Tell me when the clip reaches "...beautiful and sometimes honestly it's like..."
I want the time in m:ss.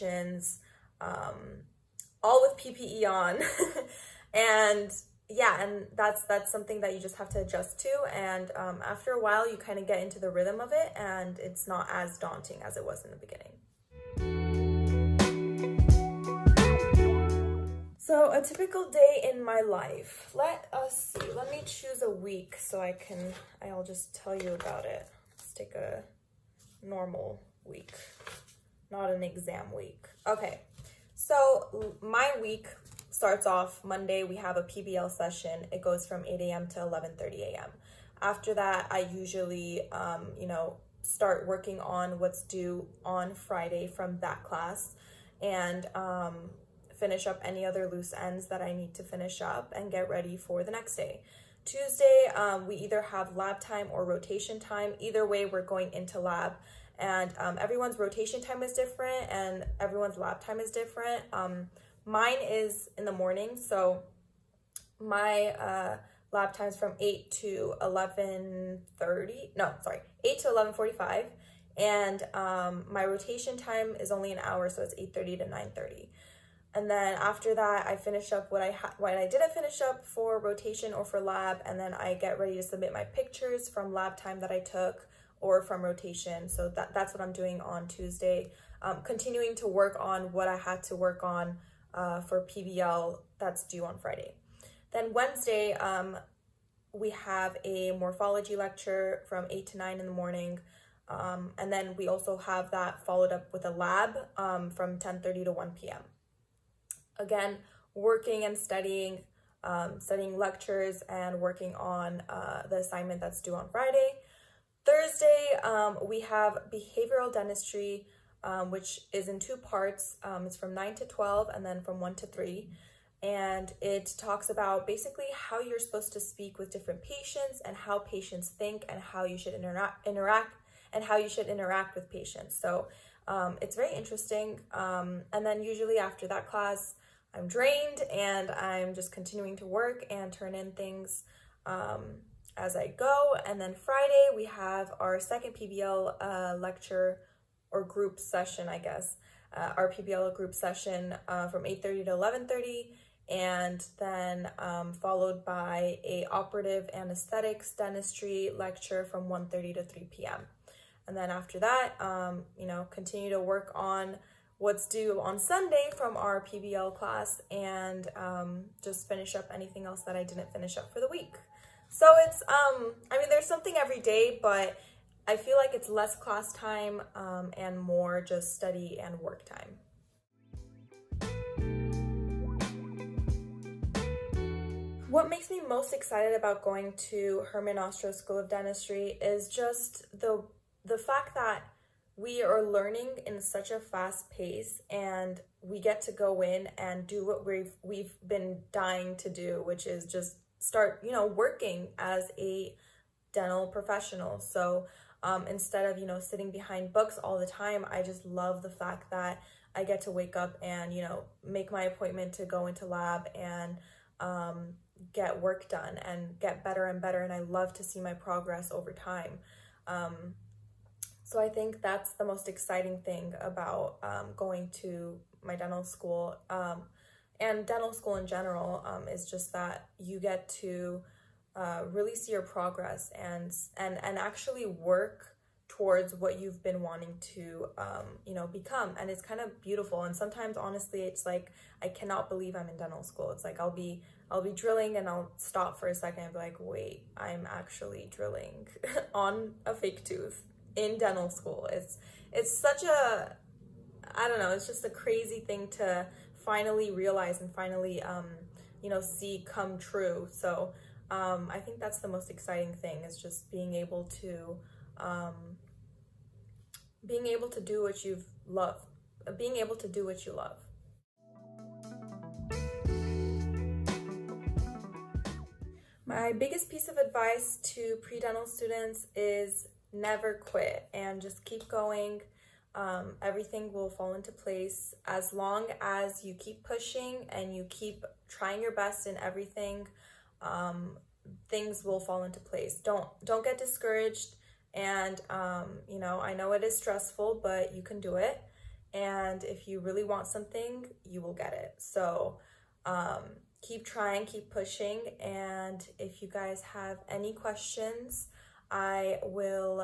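3:59.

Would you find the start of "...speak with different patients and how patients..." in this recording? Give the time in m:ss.
2:06.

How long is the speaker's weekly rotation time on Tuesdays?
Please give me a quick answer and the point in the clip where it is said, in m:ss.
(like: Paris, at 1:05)
an hour, at 1:14.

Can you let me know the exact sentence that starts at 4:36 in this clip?
My biggest piece of advice to pre-dental students is never quit and just keep going.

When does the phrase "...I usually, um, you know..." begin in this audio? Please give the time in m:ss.
0:38.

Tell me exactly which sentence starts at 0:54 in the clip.
Either way, we're going into lab and um, everyone's rotation time is different and everyone's lab time is different.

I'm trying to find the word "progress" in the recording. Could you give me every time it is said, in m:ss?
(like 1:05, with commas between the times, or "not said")
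3:38, 3:52.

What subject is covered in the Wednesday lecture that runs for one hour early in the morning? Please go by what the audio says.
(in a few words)
morphology.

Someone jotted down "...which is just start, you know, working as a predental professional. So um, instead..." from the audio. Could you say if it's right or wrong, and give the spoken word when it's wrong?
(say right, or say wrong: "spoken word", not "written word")
wrong: "dental", not "predental".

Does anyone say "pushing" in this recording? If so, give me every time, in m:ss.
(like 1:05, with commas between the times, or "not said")
4:46, 5:04.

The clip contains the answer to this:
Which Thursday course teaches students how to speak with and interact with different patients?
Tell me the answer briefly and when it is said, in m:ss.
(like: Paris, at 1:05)
behavioral dentistry, at 1:56.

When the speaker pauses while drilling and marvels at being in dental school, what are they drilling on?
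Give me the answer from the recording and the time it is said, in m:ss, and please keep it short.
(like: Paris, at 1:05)
a fake tooth, at 4:09.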